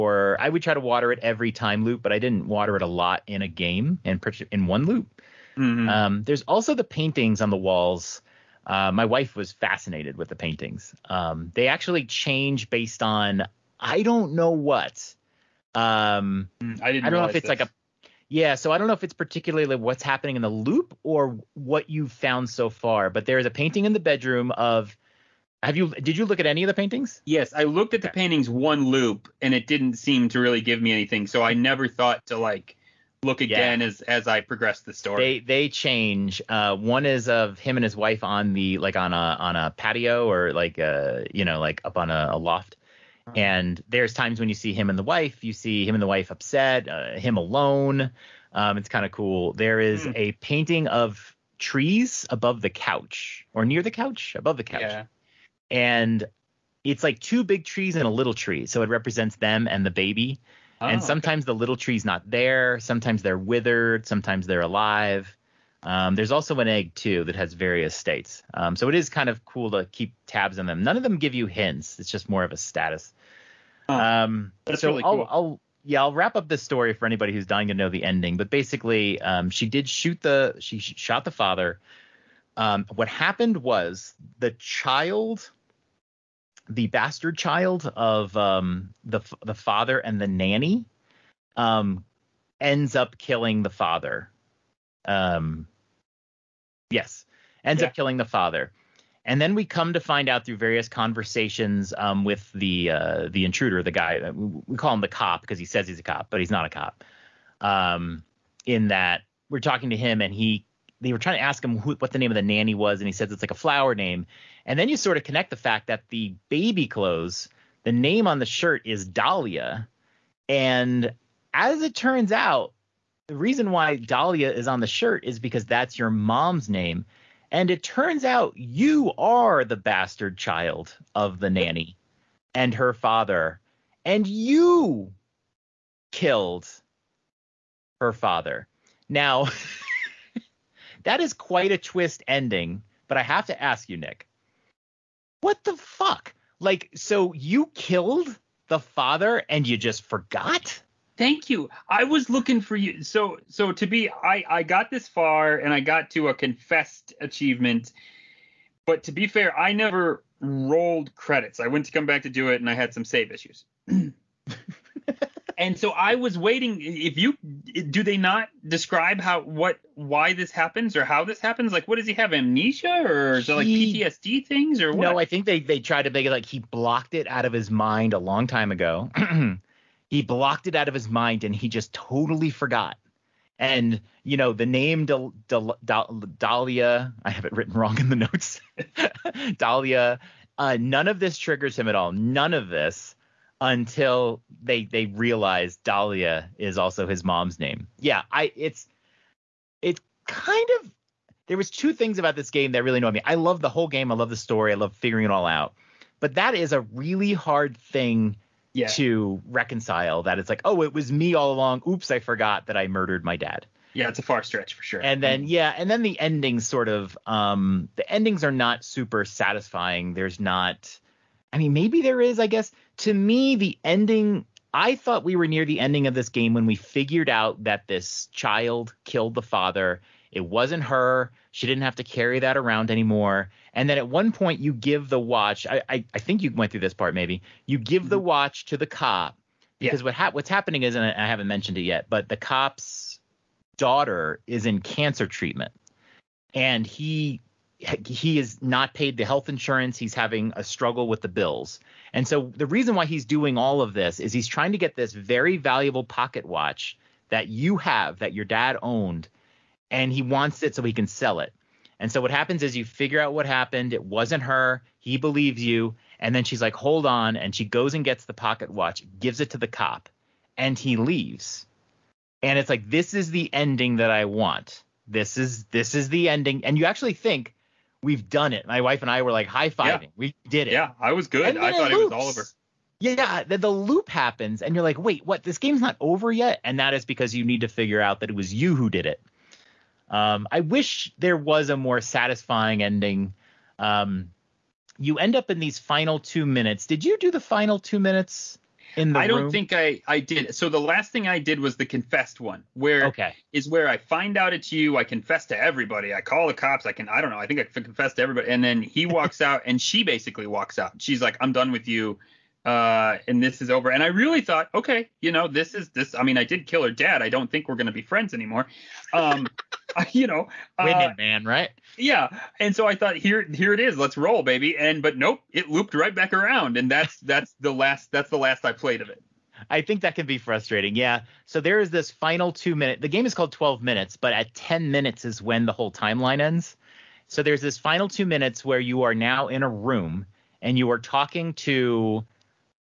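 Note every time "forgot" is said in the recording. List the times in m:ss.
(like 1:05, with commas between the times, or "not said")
2:30, 3:02, 3:32.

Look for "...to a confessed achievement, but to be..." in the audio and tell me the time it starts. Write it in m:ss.
2:36.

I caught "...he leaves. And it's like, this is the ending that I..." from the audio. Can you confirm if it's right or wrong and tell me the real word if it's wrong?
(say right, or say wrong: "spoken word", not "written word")
right.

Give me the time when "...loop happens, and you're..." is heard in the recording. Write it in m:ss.
4:43.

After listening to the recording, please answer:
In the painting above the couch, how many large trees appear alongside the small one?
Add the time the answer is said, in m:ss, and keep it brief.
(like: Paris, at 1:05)
2, at 0:57.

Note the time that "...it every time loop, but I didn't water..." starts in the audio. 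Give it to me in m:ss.
0:01.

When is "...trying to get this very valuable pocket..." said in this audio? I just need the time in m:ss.
4:14.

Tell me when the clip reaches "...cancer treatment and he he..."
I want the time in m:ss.
4:04.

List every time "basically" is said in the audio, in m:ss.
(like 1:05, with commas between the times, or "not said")
1:18, 5:10.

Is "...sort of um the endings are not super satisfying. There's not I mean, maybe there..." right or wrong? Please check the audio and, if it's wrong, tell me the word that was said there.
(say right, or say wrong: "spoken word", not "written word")
right.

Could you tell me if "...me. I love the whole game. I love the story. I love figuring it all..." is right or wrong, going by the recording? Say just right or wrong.
right.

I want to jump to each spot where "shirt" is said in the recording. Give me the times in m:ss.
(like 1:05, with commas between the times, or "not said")
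1:58, 2:04.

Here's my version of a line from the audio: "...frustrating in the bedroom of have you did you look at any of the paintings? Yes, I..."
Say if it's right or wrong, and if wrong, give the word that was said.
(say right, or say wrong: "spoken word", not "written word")
wrong: "painting", not "frustrating".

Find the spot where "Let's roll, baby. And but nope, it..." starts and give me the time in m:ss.
5:23.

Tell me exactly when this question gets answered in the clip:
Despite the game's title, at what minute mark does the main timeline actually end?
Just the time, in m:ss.
5:34.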